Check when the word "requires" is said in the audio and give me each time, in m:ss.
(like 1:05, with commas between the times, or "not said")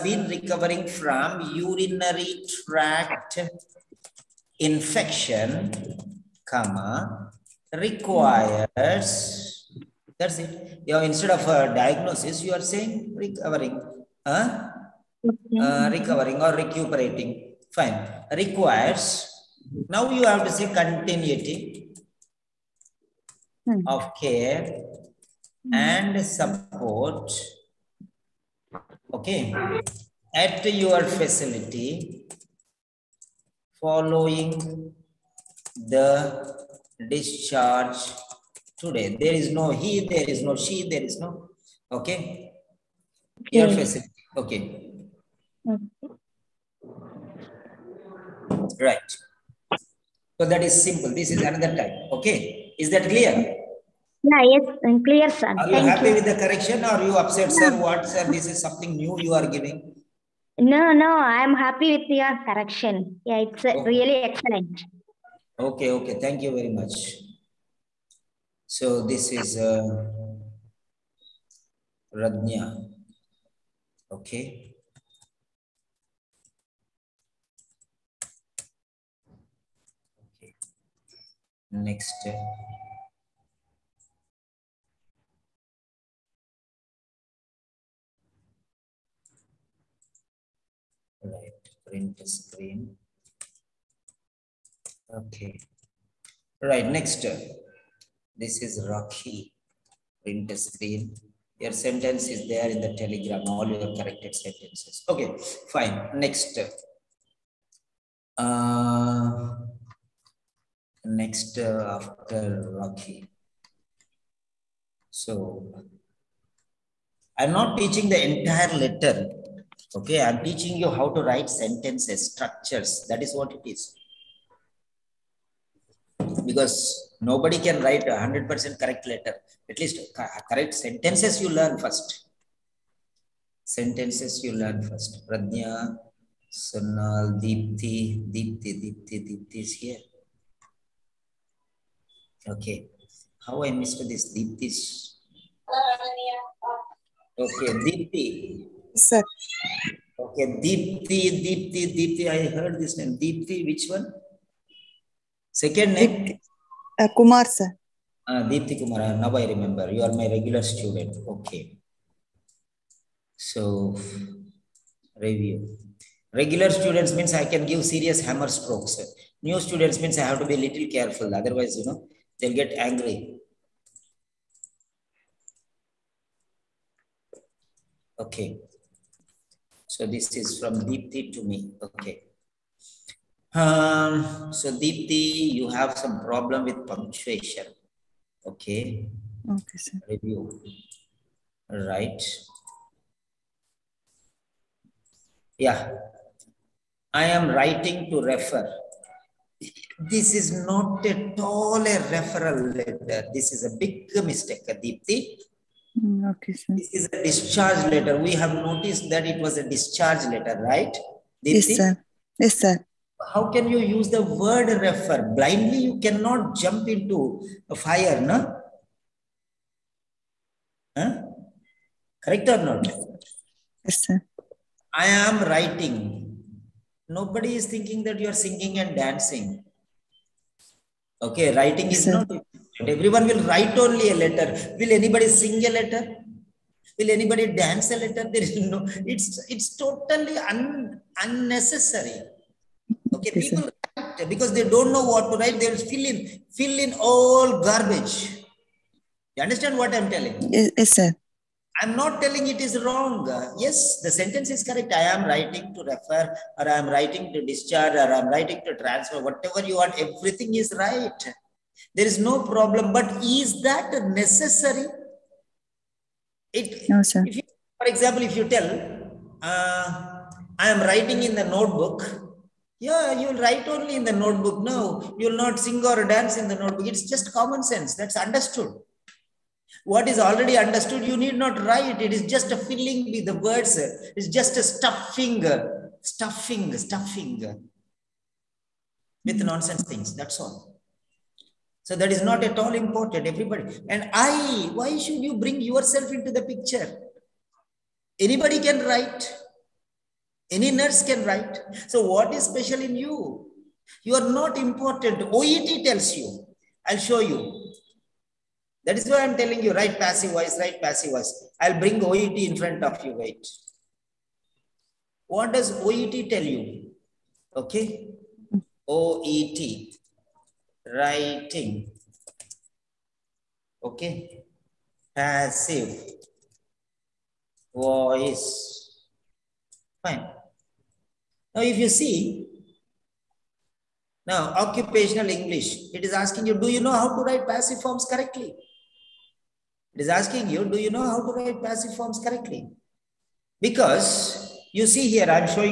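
0:07, 0:18.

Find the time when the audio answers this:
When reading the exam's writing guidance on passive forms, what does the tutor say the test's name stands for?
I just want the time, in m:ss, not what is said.
5:34.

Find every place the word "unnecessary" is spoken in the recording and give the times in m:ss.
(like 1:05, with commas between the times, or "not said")
4:01.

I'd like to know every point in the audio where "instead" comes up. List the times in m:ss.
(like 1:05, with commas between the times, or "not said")
0:11.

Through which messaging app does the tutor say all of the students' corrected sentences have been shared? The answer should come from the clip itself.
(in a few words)
Telegram.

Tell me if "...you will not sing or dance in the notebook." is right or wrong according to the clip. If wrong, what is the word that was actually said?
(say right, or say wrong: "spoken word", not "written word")
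right.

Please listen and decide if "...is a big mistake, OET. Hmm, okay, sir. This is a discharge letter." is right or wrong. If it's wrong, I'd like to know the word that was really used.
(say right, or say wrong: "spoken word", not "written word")
wrong: "Deepthi", not "OET".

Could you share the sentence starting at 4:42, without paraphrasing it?
It is just a filling with the words.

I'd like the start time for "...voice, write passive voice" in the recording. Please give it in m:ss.
5:10.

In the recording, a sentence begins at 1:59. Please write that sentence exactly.
Okay, I'm teaching you how to write sentences, structures.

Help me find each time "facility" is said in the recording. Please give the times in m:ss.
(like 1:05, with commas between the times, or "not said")
0:31, 0:43.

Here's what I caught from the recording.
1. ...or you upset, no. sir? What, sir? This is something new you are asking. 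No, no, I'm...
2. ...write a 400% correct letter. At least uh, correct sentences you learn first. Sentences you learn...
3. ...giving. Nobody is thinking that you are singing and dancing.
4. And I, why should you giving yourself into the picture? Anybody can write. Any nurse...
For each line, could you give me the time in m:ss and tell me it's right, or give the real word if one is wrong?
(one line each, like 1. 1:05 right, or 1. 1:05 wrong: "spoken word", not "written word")
1. 0:56 wrong: "giving", not "asking"
2. 2:07 wrong: "100", not "400"
3. 3:45 wrong: "writing", not "giving"
4. 4:53 wrong: "bring", not "giving".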